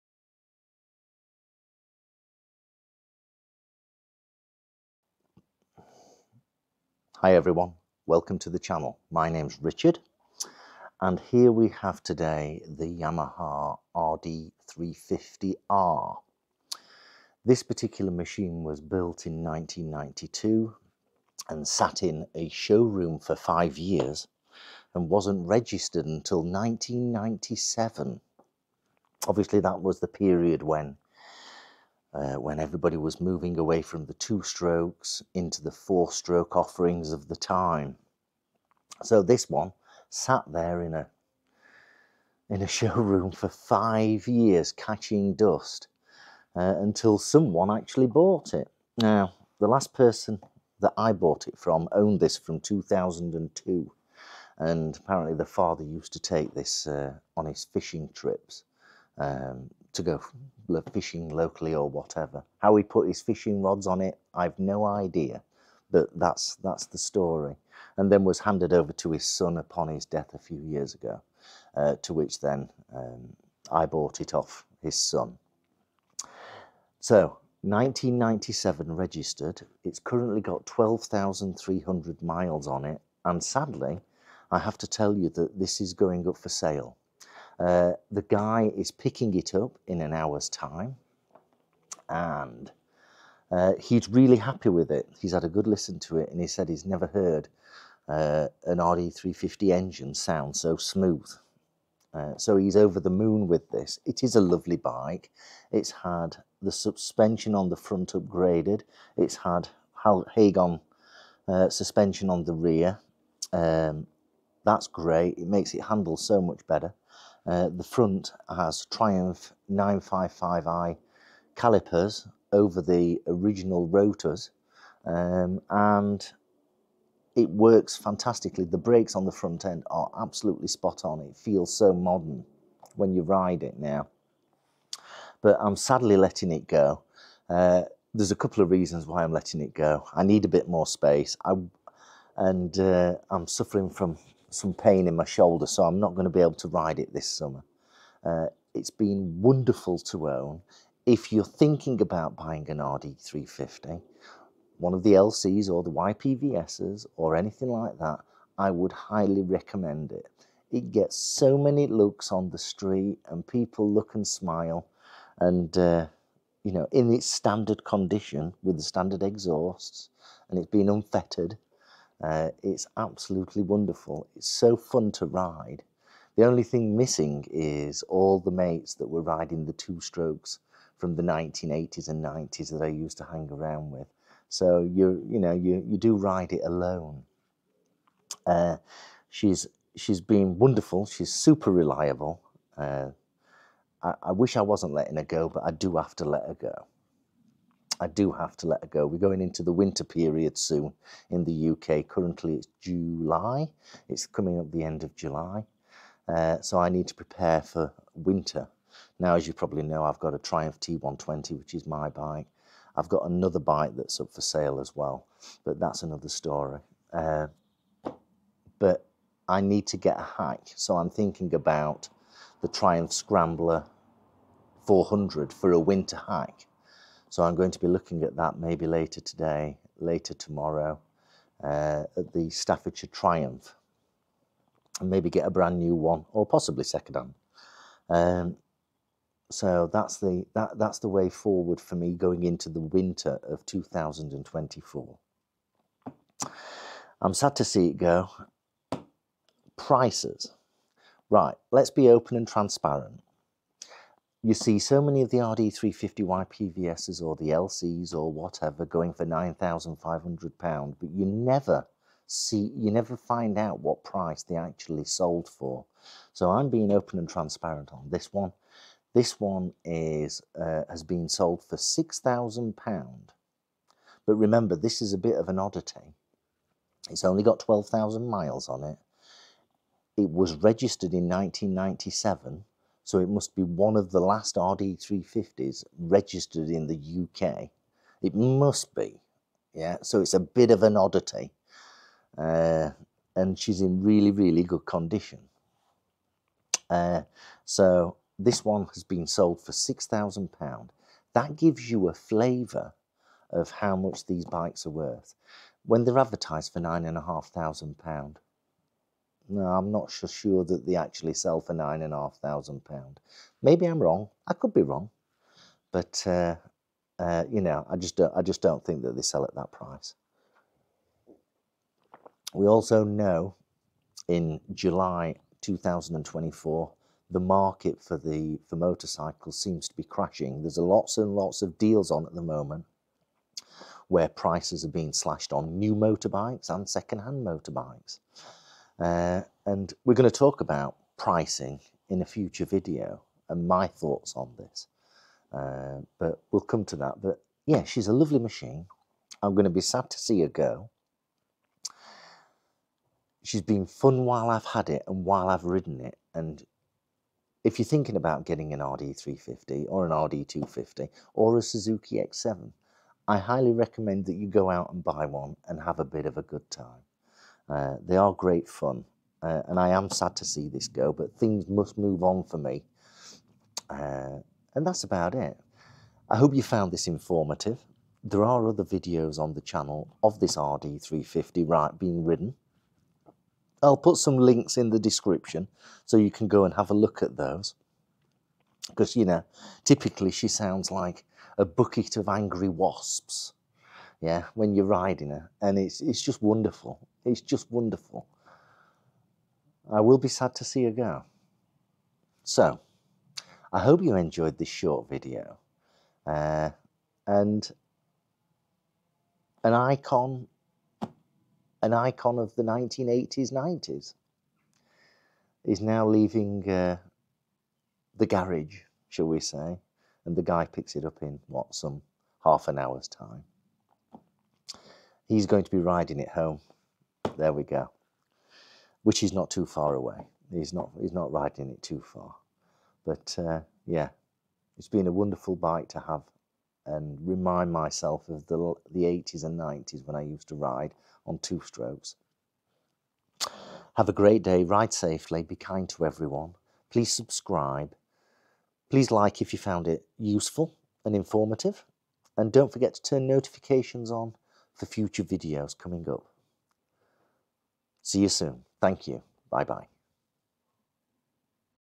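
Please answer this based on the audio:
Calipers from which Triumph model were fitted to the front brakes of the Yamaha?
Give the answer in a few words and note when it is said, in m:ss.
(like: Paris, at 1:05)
Triumph 955i, at 1:58.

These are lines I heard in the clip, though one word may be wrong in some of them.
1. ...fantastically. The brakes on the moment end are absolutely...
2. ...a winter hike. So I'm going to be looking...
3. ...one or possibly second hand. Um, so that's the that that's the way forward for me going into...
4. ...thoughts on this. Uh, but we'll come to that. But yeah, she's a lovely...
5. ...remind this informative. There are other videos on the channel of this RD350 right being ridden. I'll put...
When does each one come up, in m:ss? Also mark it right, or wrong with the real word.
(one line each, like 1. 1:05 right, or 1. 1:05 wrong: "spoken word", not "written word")
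1. 2:07 wrong: "front", not "moment"
2. 3:45 right
3. 3:55 right
4. 5:43 right
5. 6:16 wrong: "found", not "remind".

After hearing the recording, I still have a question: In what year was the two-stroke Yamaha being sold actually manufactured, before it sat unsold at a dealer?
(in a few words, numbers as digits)
1992.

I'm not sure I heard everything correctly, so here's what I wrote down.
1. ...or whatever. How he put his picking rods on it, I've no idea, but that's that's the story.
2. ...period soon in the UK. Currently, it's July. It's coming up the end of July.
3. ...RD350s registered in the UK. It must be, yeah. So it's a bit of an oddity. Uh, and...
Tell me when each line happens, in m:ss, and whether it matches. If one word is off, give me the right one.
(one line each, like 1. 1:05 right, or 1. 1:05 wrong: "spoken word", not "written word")
1. 1:01 wrong: "fishing", not "picking"
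2. 3:20 right
3. 4:44 right.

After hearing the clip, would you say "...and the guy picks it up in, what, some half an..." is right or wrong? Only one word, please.
right.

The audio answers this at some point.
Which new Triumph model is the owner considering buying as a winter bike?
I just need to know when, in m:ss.
3:42.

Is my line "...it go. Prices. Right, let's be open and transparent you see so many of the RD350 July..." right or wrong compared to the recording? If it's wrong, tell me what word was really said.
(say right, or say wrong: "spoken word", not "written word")
wrong: "YPVSs", not "July".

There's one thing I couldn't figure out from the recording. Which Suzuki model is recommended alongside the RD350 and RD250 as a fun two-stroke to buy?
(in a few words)
Suzuki X7.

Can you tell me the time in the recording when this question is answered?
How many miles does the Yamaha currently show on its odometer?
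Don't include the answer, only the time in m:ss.
1:20.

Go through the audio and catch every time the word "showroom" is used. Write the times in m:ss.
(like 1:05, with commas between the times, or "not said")
0:22, 0:42.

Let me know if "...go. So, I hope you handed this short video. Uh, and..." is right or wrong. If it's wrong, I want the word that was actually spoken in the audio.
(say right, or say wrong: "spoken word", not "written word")
wrong: "enjoyed", not "handed".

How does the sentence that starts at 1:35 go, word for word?
He's had a good listen to it and he said he's never heard uh, an RD350 engine sound so smooth.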